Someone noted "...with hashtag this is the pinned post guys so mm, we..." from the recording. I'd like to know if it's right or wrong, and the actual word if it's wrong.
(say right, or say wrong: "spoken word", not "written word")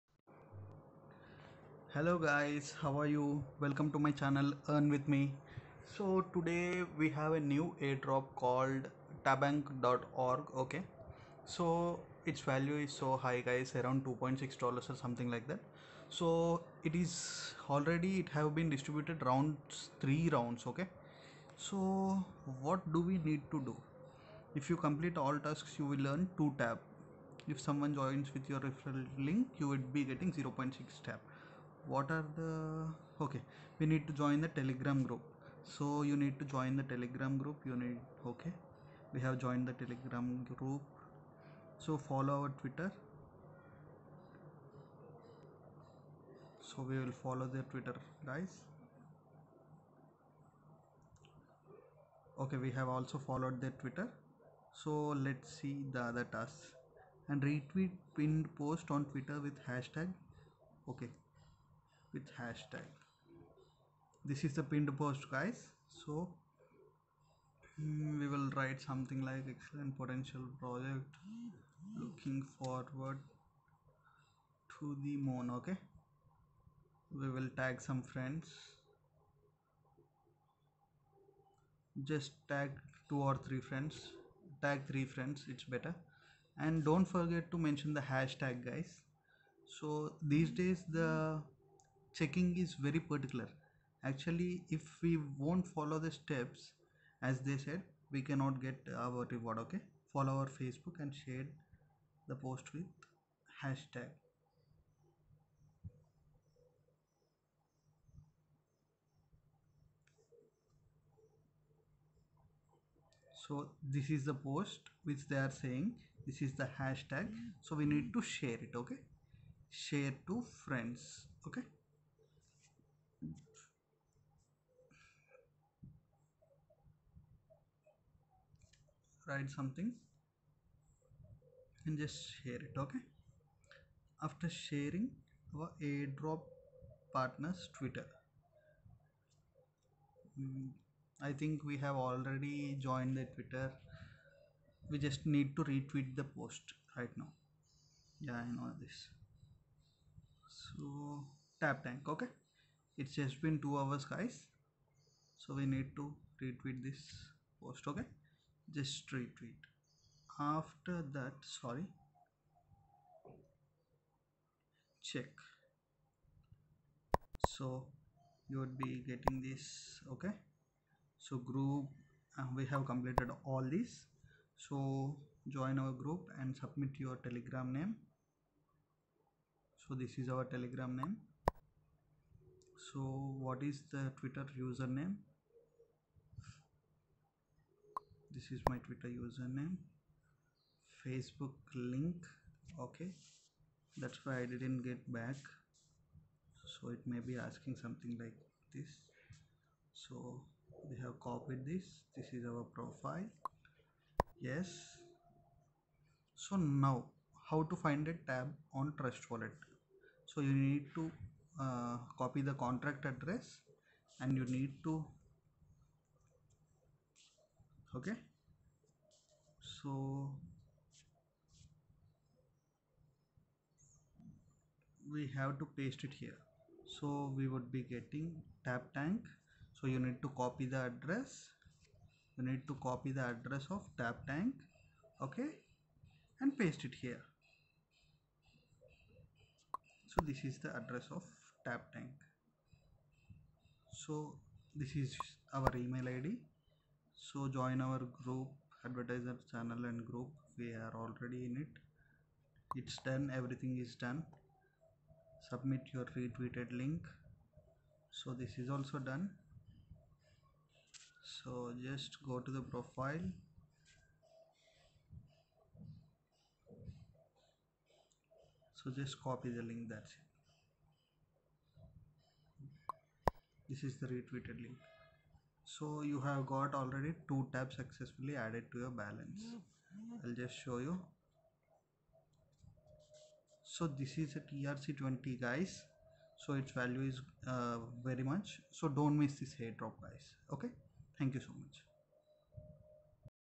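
right.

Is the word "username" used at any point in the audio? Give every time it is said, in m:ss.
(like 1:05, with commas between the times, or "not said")
3:04, 3:09.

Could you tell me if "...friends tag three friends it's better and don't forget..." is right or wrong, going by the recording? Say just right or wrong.
right.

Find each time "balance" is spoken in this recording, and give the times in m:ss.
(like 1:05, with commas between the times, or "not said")
4:38.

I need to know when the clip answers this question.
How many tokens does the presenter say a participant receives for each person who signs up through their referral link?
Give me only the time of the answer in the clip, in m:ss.
0:30.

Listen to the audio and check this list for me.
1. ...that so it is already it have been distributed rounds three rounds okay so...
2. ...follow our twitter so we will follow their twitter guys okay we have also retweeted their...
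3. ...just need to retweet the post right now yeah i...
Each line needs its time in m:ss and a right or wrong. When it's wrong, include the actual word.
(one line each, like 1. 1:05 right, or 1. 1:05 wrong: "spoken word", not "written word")
1. 0:15 right
2. 0:41 wrong: "followed", not "retweeted"
3. 2:25 right.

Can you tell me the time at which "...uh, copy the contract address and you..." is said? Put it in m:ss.
3:31.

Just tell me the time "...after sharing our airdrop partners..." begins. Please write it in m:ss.
2:14.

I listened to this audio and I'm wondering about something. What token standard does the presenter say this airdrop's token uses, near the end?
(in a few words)
TRC20.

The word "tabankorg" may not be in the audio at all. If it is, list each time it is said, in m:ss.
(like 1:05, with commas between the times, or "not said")
0:09.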